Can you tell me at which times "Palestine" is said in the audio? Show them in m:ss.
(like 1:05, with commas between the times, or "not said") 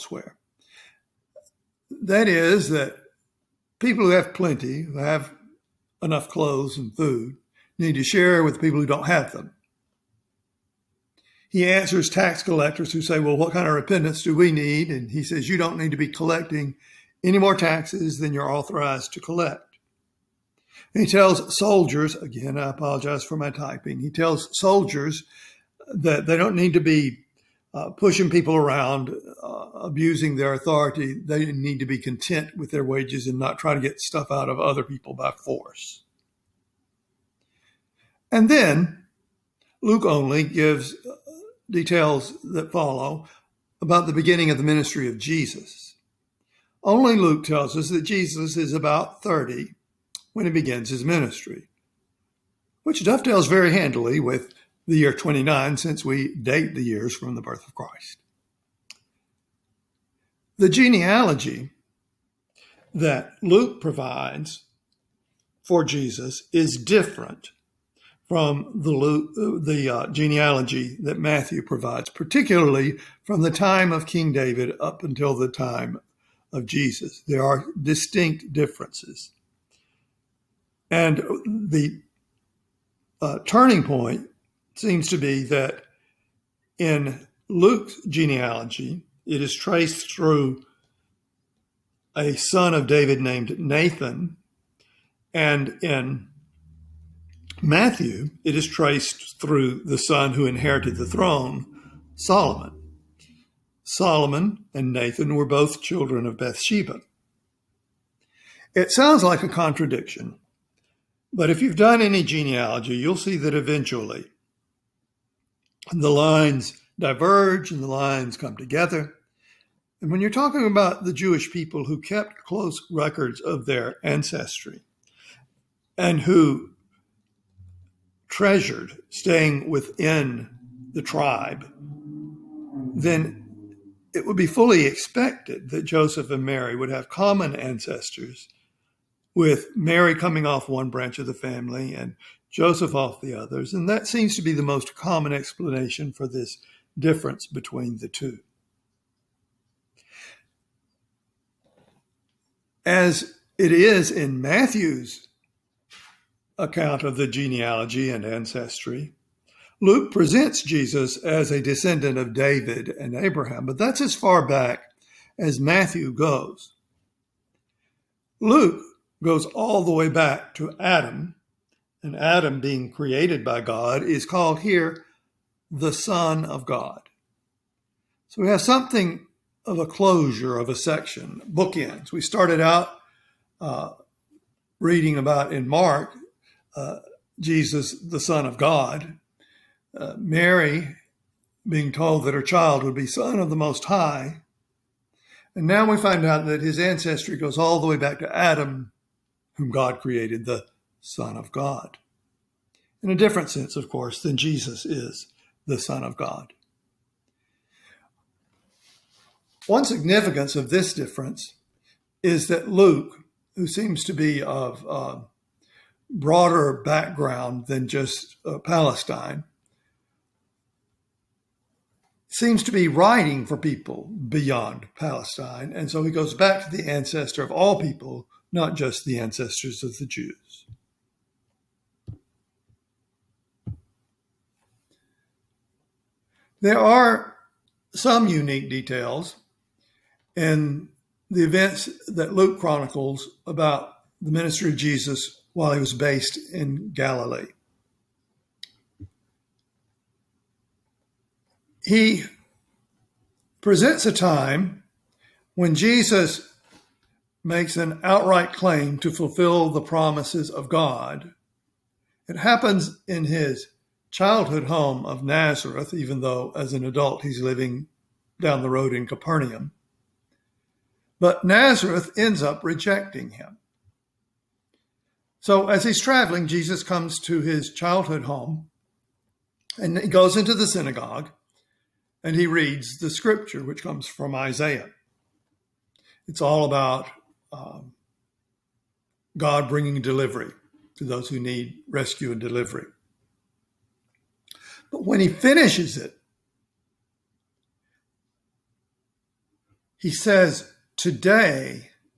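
3:38, 3:44.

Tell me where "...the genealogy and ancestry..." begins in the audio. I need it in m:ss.
2:37.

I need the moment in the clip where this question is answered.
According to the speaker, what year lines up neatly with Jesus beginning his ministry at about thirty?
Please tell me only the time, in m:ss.
0:54.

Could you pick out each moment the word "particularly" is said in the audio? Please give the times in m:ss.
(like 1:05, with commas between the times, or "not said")
1:12.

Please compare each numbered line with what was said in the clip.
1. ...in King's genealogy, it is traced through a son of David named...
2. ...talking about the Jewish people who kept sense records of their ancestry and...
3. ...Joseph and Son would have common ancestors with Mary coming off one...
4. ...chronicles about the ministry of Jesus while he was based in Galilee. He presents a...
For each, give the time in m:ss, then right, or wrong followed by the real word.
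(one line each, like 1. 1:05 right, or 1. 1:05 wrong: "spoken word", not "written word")
1. 1:26 wrong: "Luke", not "King"
2. 2:00 wrong: "close", not "sense"
3. 2:15 wrong: "Mary", not "Son"
4. 4:02 right.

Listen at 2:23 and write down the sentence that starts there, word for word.
And that seems to be the most common explanation for this difference between the two.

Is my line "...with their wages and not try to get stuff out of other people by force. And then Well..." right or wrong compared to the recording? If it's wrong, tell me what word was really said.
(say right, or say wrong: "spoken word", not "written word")
wrong: "Luke", not "Well".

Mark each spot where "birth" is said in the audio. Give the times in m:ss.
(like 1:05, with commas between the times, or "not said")
0:57.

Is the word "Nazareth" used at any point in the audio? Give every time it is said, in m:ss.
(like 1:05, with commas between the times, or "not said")
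4:25, 4:31.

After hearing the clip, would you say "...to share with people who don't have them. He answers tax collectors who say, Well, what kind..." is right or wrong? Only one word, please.
right.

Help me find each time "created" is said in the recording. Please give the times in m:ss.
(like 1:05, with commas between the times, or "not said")
2:52, 3:19.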